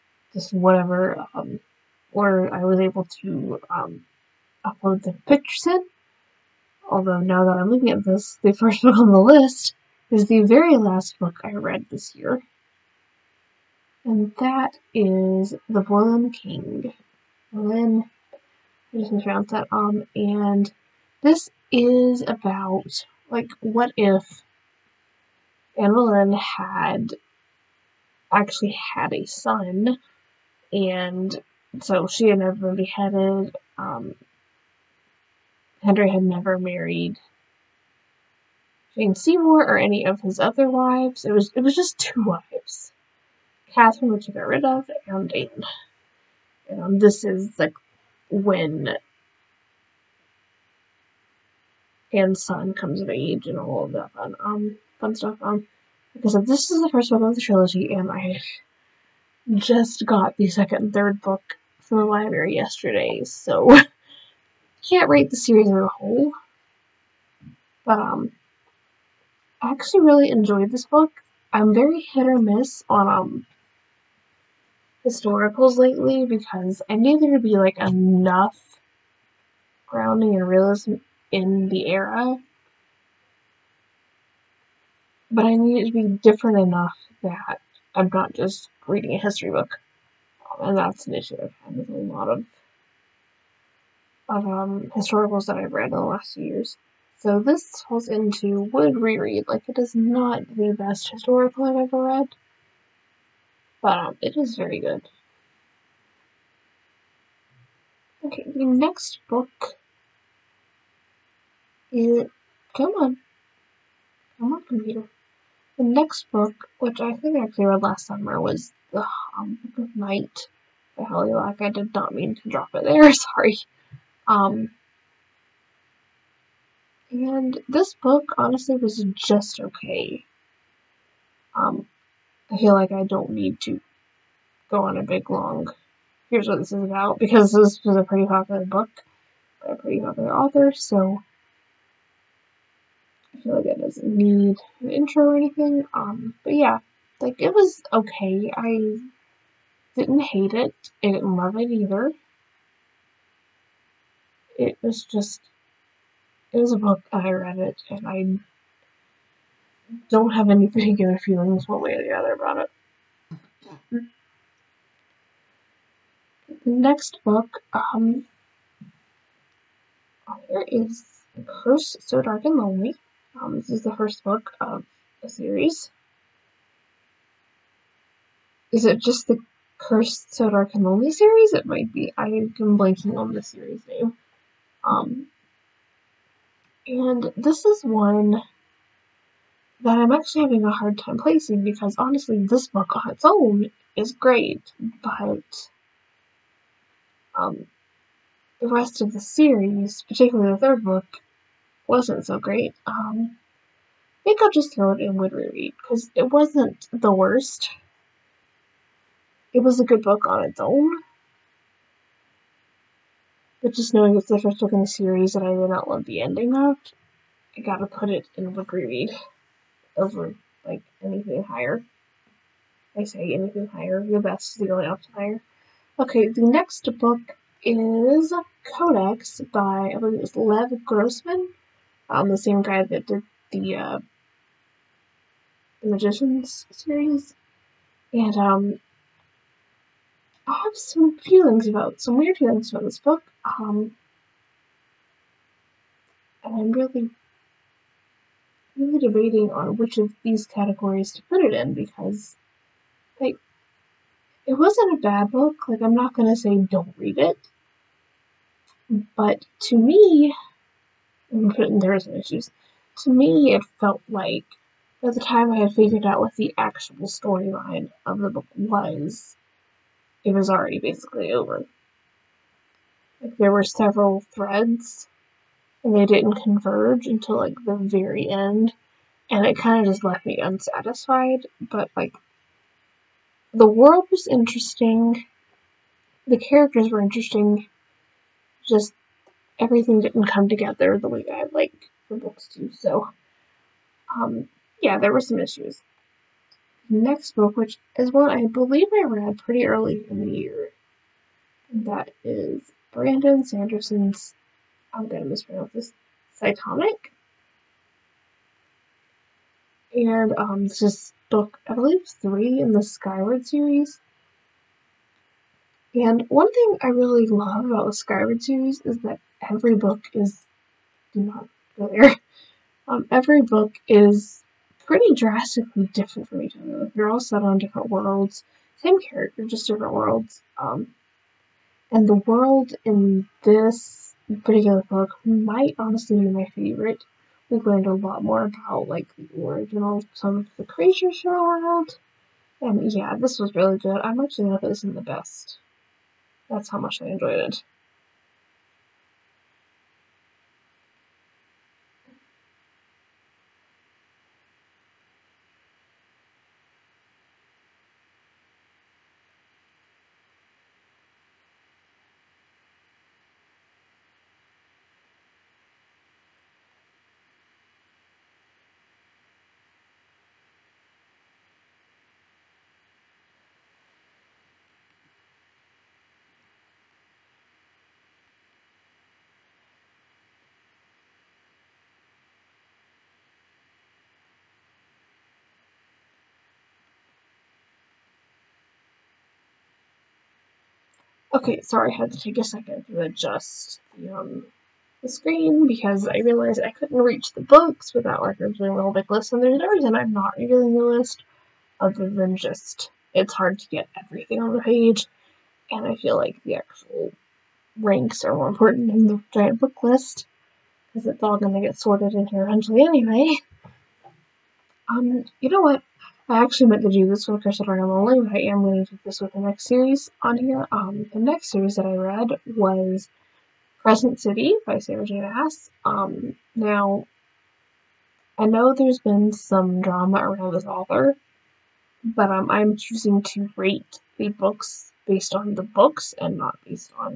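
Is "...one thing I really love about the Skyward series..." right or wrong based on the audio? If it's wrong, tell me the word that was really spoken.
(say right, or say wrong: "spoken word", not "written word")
right.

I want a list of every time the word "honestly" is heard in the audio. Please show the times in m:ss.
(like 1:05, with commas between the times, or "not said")
2:08, 3:11, 5:35.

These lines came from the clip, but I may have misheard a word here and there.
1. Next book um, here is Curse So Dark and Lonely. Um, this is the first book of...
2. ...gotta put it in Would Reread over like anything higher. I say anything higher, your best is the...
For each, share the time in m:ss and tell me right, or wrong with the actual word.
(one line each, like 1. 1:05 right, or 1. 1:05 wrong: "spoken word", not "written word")
1. 2:46 right
2. 3:37 right.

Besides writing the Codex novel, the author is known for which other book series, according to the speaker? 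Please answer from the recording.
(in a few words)
the Magicians.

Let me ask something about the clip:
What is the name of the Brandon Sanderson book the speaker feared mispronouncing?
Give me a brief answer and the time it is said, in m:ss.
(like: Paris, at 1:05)
Cytonic, at 5:06.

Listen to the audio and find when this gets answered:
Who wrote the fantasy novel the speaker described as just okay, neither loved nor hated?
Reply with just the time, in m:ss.
2:01.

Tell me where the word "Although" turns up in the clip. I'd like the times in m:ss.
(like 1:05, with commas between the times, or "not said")
0:06.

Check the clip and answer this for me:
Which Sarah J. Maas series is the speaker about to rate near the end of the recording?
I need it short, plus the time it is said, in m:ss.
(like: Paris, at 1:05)
Crescent City, at 7:03.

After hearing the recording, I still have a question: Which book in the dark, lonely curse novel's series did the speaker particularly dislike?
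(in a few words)
the third book.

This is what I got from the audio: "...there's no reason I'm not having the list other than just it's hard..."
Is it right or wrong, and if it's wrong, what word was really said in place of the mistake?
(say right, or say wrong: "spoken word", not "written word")
wrong: "reviewing", not "having".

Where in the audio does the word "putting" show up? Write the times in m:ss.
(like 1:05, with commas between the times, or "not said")
4:21.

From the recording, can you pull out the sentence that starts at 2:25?
Um, but yeah, like it was okay.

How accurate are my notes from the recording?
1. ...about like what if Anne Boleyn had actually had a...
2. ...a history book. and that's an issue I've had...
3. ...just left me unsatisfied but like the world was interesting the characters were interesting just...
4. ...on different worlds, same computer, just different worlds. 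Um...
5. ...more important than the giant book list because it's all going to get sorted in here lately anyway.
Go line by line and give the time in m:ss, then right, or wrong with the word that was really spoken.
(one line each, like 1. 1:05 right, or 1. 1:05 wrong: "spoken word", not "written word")
1. 0:22 right
2. 1:29 right
3. 4:39 right
4. 5:27 wrong: "character", not "computer"
5. 6:48 wrong: "eventually", not "lately".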